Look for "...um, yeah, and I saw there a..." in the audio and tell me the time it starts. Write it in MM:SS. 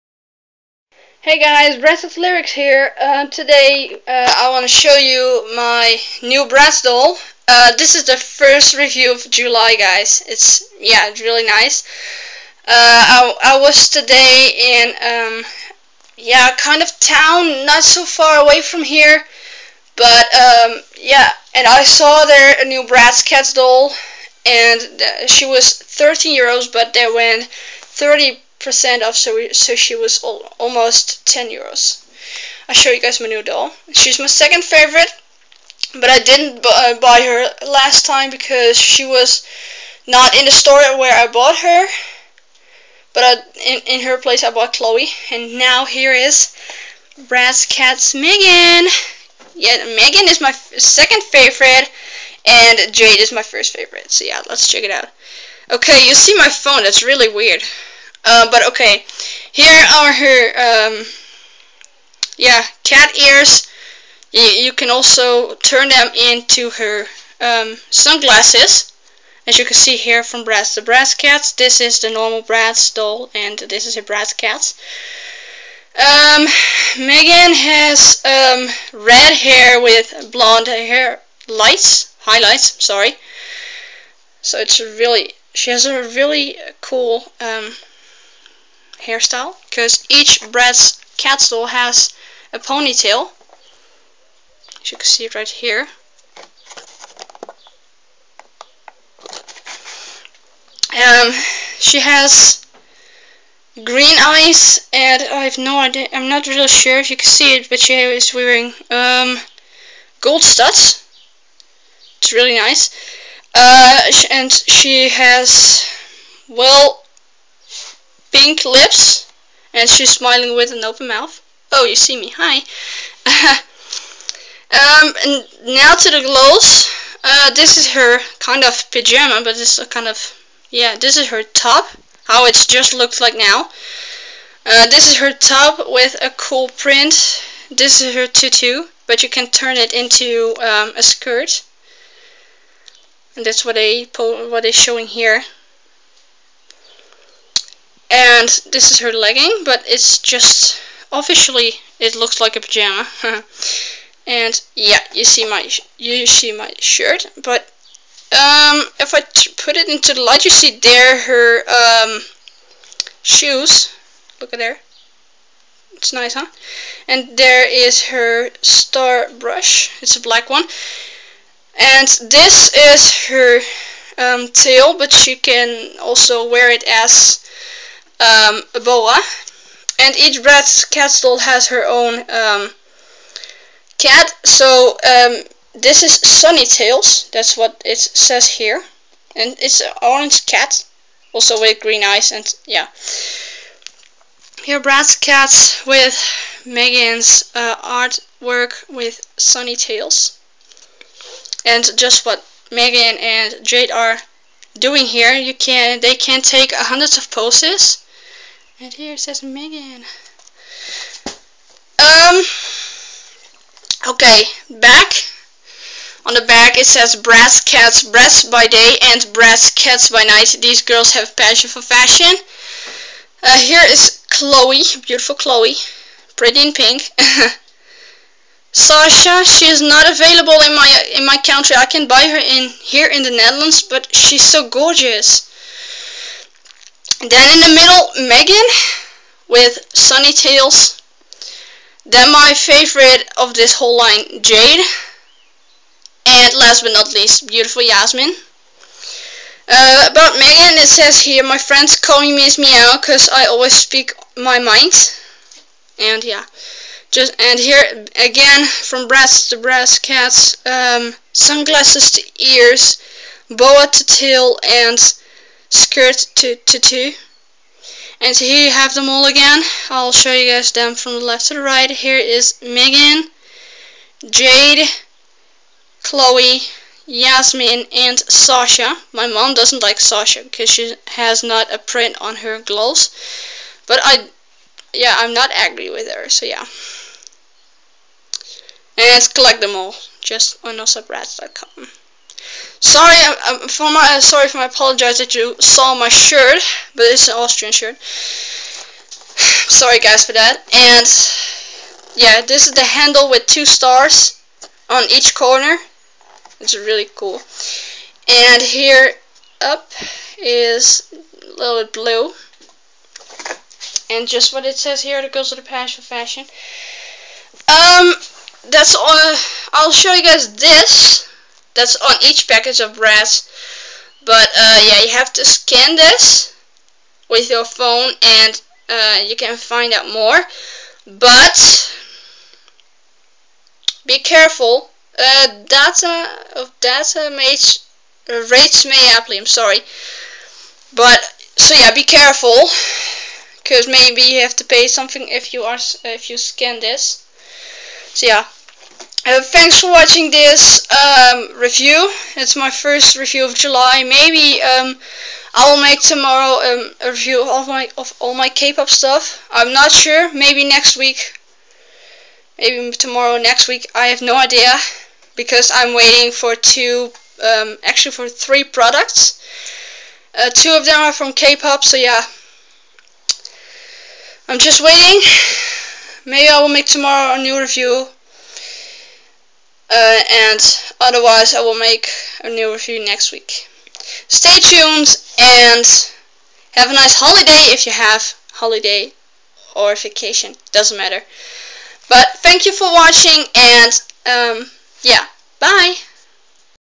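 00:20.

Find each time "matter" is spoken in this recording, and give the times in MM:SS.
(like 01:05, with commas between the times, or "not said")
06:30.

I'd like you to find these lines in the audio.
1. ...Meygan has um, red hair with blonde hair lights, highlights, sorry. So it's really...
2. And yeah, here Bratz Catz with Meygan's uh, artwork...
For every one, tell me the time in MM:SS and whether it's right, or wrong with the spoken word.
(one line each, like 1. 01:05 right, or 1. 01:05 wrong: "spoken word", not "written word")
1. 01:16 right
2. 03:12 right.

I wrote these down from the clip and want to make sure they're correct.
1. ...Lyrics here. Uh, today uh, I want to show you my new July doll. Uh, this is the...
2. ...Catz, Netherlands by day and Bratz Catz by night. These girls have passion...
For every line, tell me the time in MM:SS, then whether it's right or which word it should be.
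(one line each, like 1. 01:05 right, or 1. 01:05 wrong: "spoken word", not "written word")
1. 00:02 wrong: "Bratz", not "July"
2. 03:37 wrong: "Bratz", not "Netherlands".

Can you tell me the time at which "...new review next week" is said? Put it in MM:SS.
06:22.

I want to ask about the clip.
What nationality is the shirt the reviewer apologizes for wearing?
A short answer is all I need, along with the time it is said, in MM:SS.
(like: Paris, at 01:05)
Austrian, at 04:57.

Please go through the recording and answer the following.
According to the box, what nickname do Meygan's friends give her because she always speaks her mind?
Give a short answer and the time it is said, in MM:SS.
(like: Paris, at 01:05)
Miss Meow, at 04:12.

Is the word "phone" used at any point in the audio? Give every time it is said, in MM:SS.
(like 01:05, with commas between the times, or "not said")
00:56, 05:27.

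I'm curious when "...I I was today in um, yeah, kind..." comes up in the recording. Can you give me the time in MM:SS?
00:12.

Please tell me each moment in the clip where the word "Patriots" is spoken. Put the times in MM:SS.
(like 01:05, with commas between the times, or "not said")
not said.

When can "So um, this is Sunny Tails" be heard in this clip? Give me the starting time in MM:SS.
03:04.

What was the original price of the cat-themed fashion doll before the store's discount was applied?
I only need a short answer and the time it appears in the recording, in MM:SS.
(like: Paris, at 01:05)
13 euros, at 00:25.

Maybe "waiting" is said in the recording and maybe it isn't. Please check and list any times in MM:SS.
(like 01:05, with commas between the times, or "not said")
06:05, 06:14.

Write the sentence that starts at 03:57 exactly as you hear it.
Then in the middle, Meygan with Sunny Tails.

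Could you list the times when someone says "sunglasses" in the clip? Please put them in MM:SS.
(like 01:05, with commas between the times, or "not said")
01:07, 04:21.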